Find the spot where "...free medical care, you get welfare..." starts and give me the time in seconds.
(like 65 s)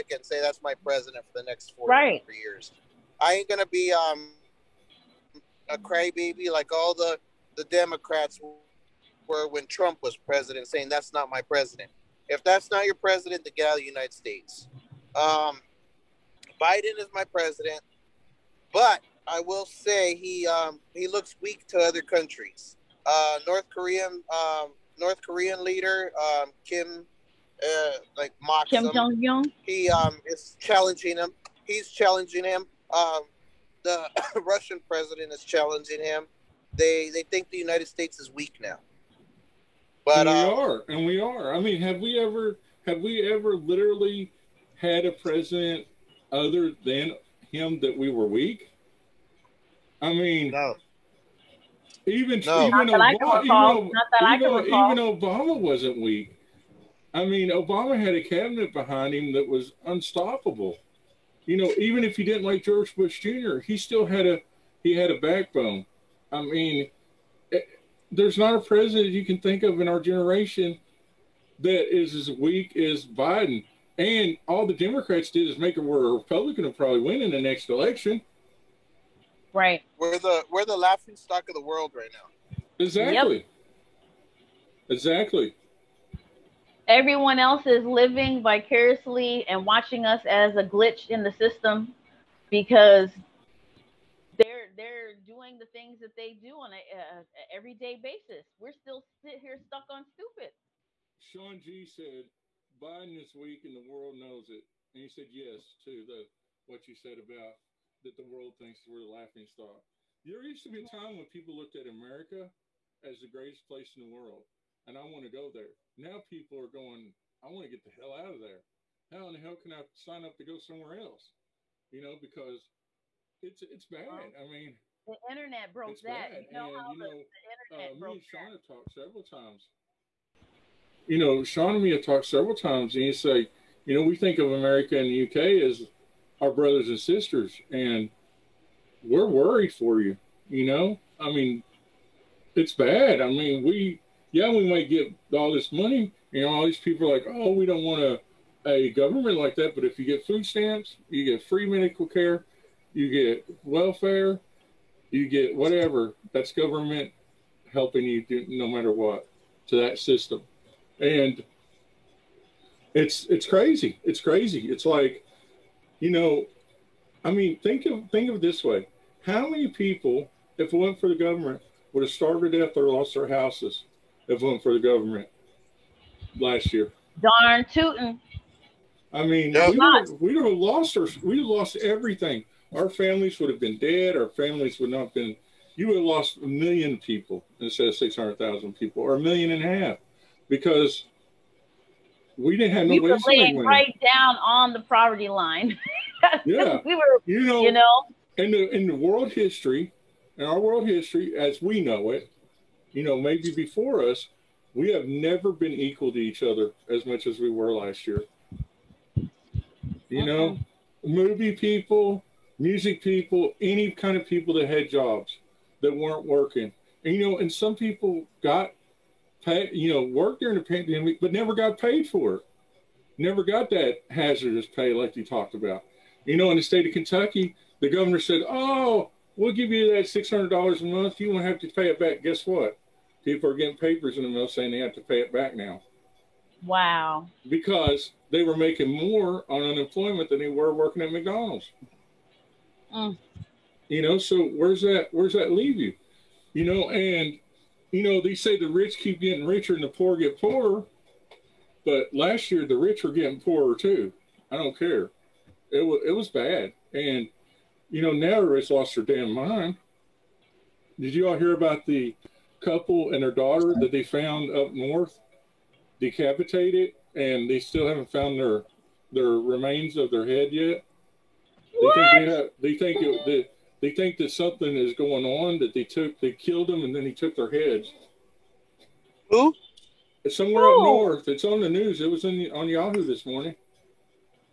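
151 s.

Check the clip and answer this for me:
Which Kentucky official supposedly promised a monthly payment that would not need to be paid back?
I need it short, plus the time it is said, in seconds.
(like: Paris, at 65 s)
the governor, at 227 s.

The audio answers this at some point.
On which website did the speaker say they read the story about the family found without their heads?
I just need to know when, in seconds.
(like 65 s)
282 s.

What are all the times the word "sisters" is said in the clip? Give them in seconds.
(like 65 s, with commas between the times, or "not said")
136 s.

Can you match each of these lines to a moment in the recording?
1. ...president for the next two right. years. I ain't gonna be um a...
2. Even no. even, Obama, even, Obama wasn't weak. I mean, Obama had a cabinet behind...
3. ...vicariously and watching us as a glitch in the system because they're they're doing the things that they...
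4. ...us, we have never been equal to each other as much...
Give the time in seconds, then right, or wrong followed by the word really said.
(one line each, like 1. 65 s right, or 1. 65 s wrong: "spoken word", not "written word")
1. 0 s wrong: "four", not "two"
2. 52 s right
3. 88 s right
4. 204 s right.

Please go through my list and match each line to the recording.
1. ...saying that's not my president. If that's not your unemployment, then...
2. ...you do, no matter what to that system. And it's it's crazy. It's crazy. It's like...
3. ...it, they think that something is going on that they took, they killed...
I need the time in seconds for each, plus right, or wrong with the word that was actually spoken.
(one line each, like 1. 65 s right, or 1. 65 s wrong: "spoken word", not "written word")
1. 10 s wrong: "president", not "unemployment"
2. 158 s right
3. 273 s right.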